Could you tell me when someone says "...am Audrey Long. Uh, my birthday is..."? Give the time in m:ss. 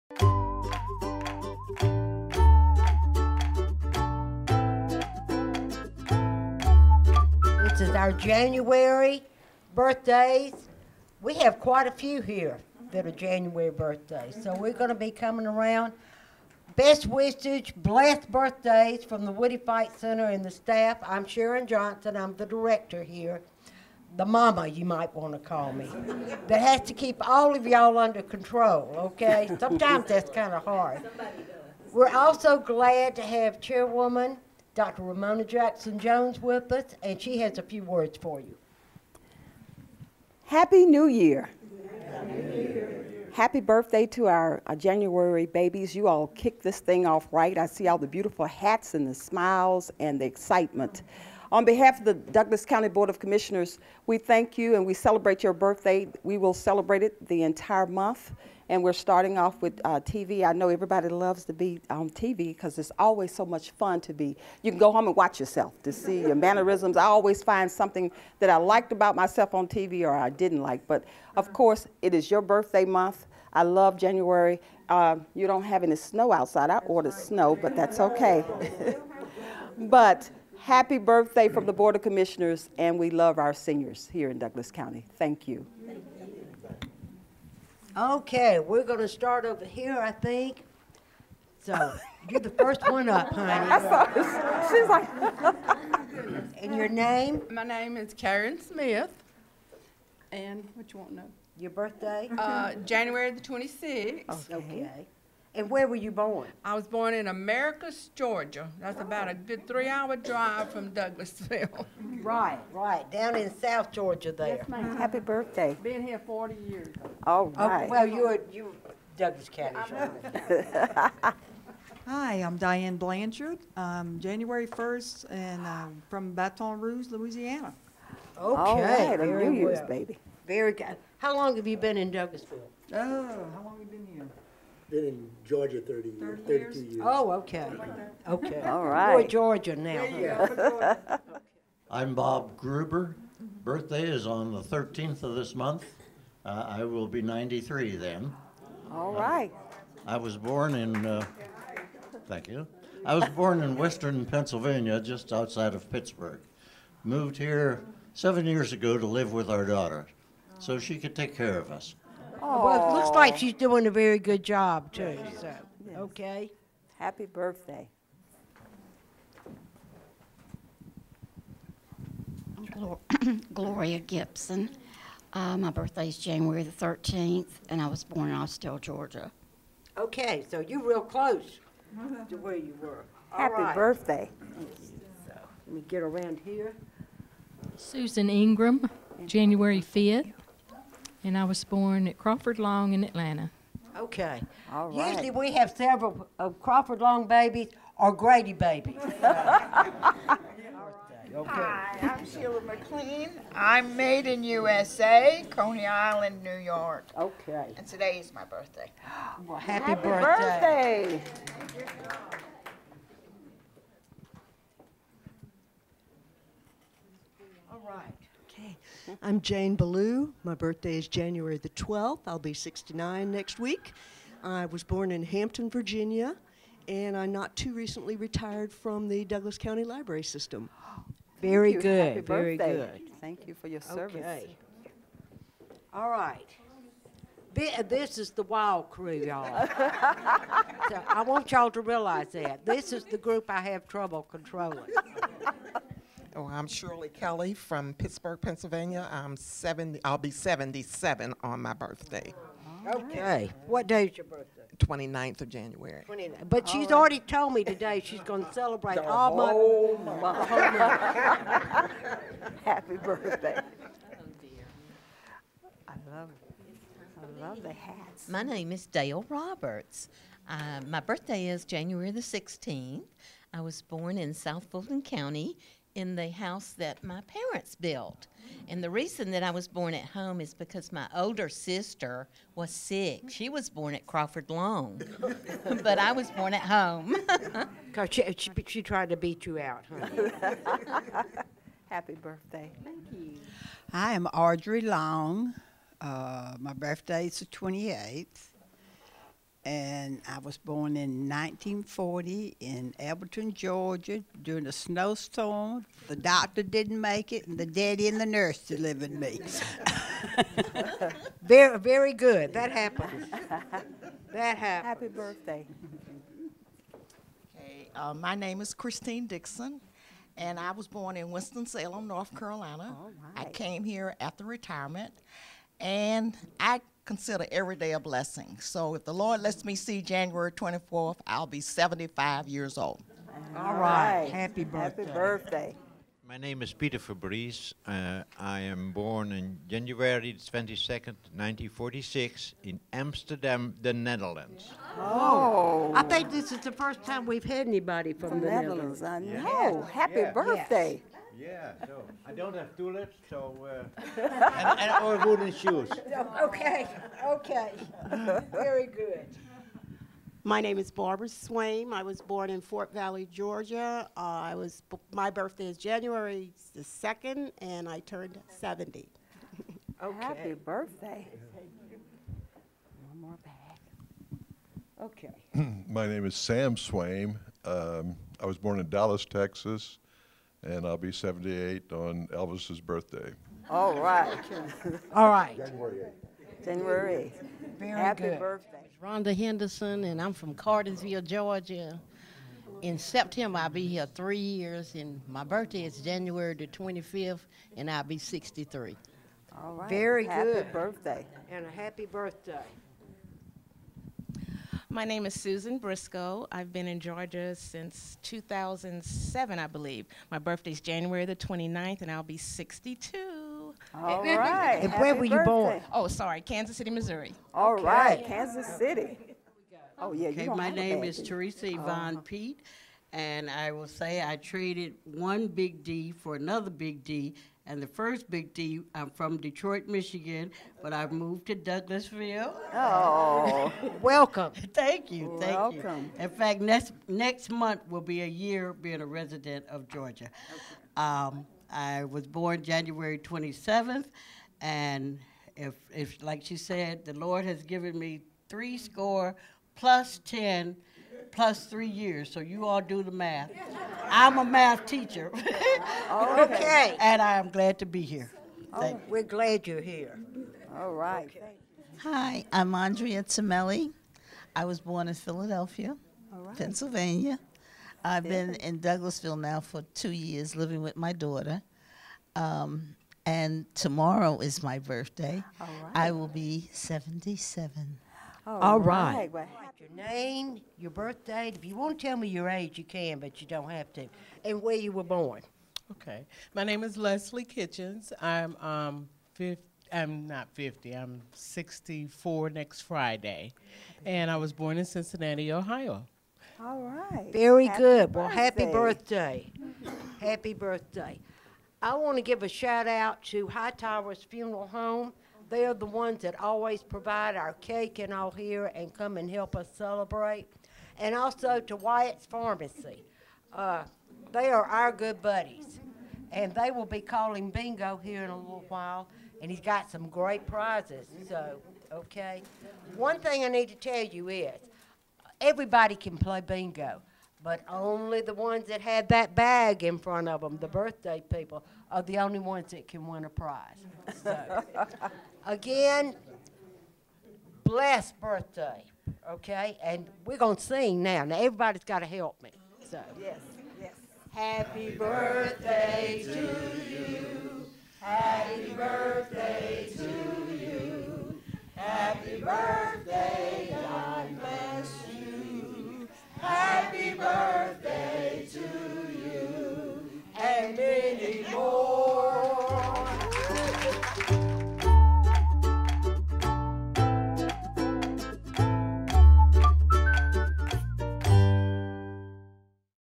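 4:54.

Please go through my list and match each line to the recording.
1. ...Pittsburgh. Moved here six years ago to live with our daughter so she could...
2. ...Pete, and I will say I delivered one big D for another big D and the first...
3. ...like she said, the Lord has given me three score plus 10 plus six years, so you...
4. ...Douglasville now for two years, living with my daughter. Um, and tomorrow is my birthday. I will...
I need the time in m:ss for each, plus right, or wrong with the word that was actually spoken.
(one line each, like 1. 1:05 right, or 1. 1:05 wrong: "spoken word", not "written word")
1. 2:35 wrong: "seven", not "six"
2. 7:02 wrong: "traded", not "delivered"
3. 7:26 wrong: "three", not "six"
4. 7:48 right.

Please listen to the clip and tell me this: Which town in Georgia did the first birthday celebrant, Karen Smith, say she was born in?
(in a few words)
Americus.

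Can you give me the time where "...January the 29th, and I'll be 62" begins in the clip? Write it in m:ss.
6:50.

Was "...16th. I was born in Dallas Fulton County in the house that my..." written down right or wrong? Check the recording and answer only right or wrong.
wrong.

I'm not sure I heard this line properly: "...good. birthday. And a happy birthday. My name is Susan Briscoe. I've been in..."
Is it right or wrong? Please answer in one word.
right.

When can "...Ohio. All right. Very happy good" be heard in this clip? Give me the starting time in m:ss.
8:15.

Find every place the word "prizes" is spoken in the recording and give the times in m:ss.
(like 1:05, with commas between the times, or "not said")
8:40, 8:53.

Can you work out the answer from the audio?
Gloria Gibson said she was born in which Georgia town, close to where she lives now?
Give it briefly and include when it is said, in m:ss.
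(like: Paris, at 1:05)
Austell, at 2:58.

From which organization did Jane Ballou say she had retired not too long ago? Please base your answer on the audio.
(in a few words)
Douglas County Library System.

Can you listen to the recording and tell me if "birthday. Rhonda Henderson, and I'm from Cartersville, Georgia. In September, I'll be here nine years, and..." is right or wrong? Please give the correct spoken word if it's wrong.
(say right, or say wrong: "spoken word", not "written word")
wrong: "three", not "nine".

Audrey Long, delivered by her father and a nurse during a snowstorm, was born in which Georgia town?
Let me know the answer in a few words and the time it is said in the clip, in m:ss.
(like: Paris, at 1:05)
Elberton, at 5:02.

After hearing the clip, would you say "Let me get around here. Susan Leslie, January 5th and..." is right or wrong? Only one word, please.
wrong.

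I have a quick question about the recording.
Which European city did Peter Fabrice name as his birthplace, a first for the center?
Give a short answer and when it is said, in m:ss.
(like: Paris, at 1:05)
Amsterdam, at 5:42.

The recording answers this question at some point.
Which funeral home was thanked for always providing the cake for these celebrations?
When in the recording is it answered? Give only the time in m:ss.
8:23.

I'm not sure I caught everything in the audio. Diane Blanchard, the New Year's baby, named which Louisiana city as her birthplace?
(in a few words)
Baton Rouge.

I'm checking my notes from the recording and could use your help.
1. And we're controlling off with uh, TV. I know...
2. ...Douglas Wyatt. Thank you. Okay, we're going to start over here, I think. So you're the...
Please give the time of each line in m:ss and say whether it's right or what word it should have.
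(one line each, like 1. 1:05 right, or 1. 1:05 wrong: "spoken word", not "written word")
1. 0:58 wrong: "starting", not "controlling"
2. 1:24 wrong: "County", not "Wyatt".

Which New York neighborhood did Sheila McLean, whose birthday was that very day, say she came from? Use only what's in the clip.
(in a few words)
Coney Island.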